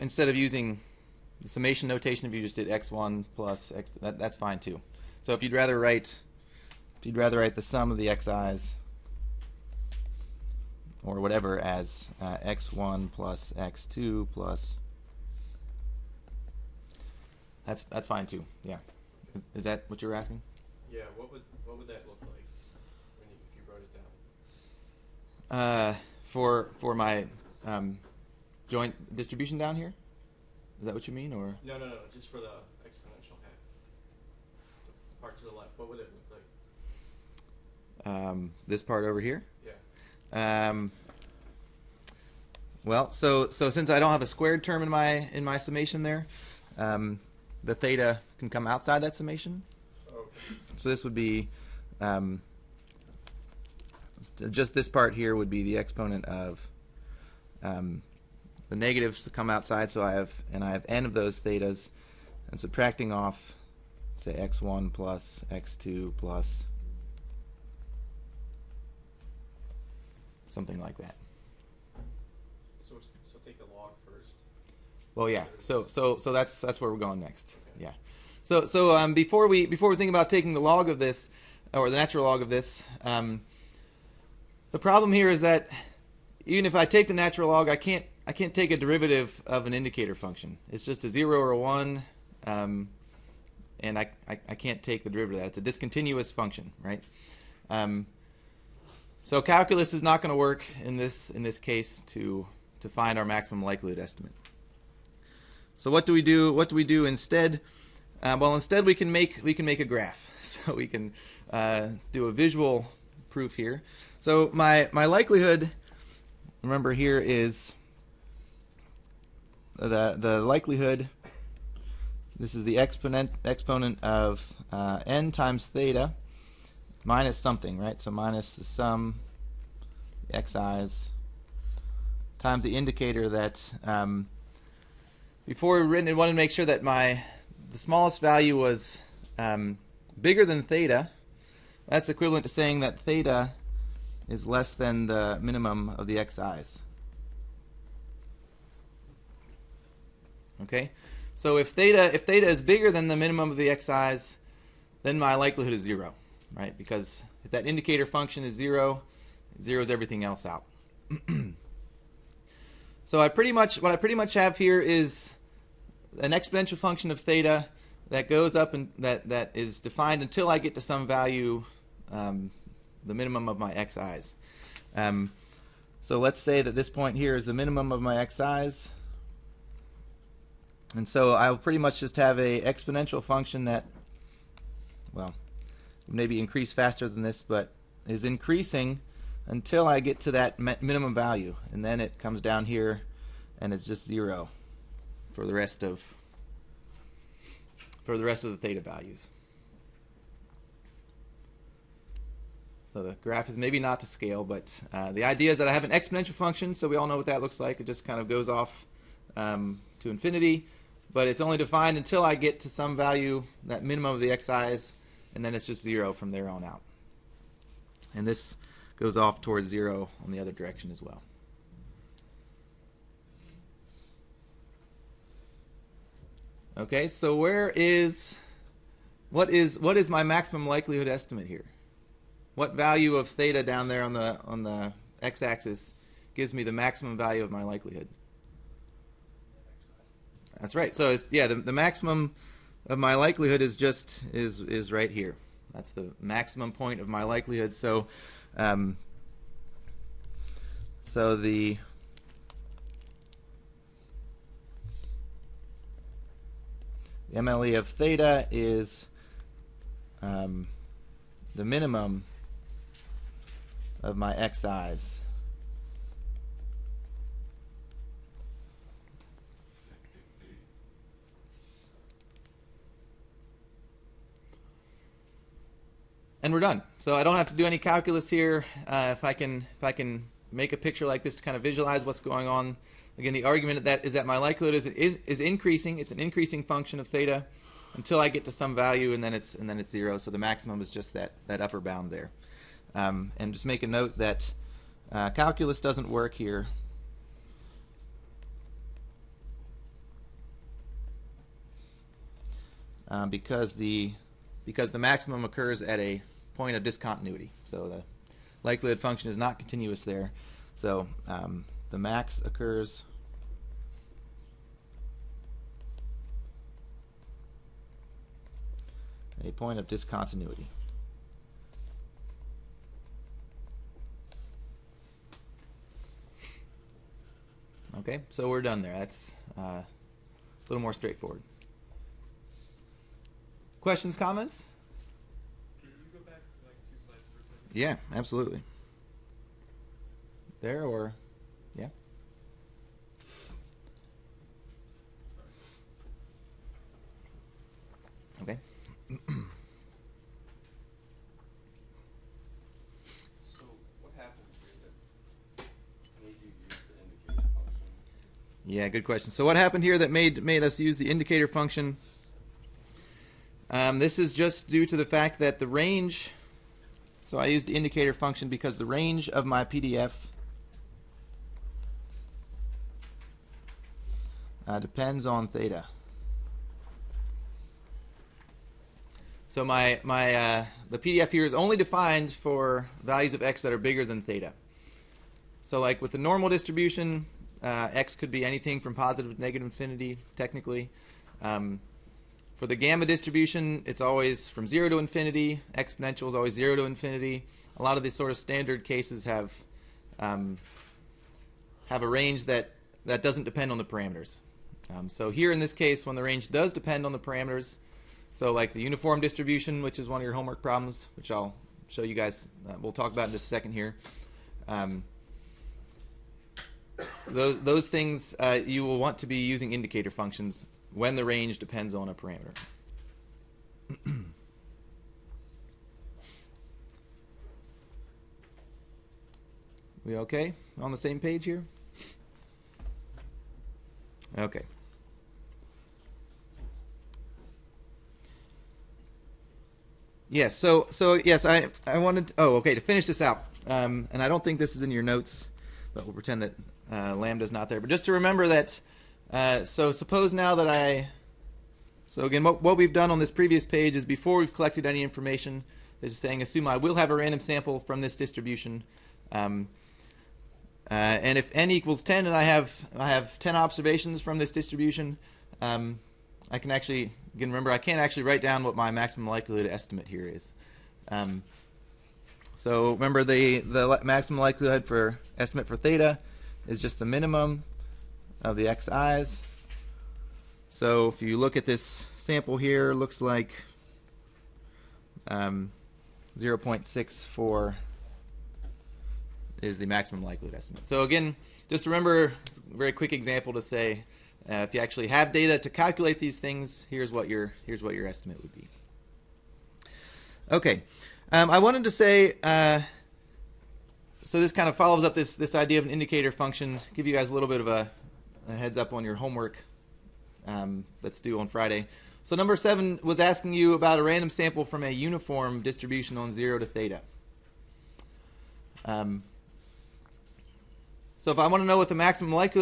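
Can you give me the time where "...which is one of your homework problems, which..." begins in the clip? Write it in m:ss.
6:49.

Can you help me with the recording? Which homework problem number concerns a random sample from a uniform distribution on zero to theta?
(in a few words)
7.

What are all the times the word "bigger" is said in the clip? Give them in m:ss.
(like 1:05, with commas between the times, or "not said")
2:20, 2:32, 6:23.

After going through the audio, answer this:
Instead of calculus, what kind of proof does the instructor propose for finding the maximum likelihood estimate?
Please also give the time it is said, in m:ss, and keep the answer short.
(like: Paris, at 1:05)
A visual proof, at 1:52.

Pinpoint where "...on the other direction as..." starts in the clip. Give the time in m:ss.
3:40.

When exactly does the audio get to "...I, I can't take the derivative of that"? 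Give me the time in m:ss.
1:34.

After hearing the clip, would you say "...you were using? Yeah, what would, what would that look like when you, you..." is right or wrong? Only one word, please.
wrong.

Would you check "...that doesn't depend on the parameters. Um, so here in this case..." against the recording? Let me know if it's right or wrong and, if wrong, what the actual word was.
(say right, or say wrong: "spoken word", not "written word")
right.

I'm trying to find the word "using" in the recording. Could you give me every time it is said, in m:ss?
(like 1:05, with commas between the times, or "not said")
0:00, 6:59.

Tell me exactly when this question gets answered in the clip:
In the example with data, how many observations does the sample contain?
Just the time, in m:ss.
7:43.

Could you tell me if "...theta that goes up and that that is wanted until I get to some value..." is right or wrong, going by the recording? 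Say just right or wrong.
wrong.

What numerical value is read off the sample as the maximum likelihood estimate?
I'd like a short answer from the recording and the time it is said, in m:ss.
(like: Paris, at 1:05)
0.64, at 8:06.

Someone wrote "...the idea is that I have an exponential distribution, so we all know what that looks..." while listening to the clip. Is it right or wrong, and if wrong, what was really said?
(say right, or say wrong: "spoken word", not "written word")
wrong: "function", not "distribution".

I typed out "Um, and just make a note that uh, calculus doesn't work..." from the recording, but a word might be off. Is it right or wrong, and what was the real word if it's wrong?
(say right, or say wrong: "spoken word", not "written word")
right.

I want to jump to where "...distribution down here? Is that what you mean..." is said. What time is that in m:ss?
0:29.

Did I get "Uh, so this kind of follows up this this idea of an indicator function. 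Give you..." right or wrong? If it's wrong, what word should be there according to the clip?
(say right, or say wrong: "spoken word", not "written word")
right.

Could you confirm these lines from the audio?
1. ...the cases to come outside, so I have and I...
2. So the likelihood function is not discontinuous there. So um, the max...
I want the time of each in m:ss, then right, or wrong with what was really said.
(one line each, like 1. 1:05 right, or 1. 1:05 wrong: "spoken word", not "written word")
1. 0:58 wrong: "negatives", not "cases"
2. 5:07 wrong: "continuous", not "discontinuous".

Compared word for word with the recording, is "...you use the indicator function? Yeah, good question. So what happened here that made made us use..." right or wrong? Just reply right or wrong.
right.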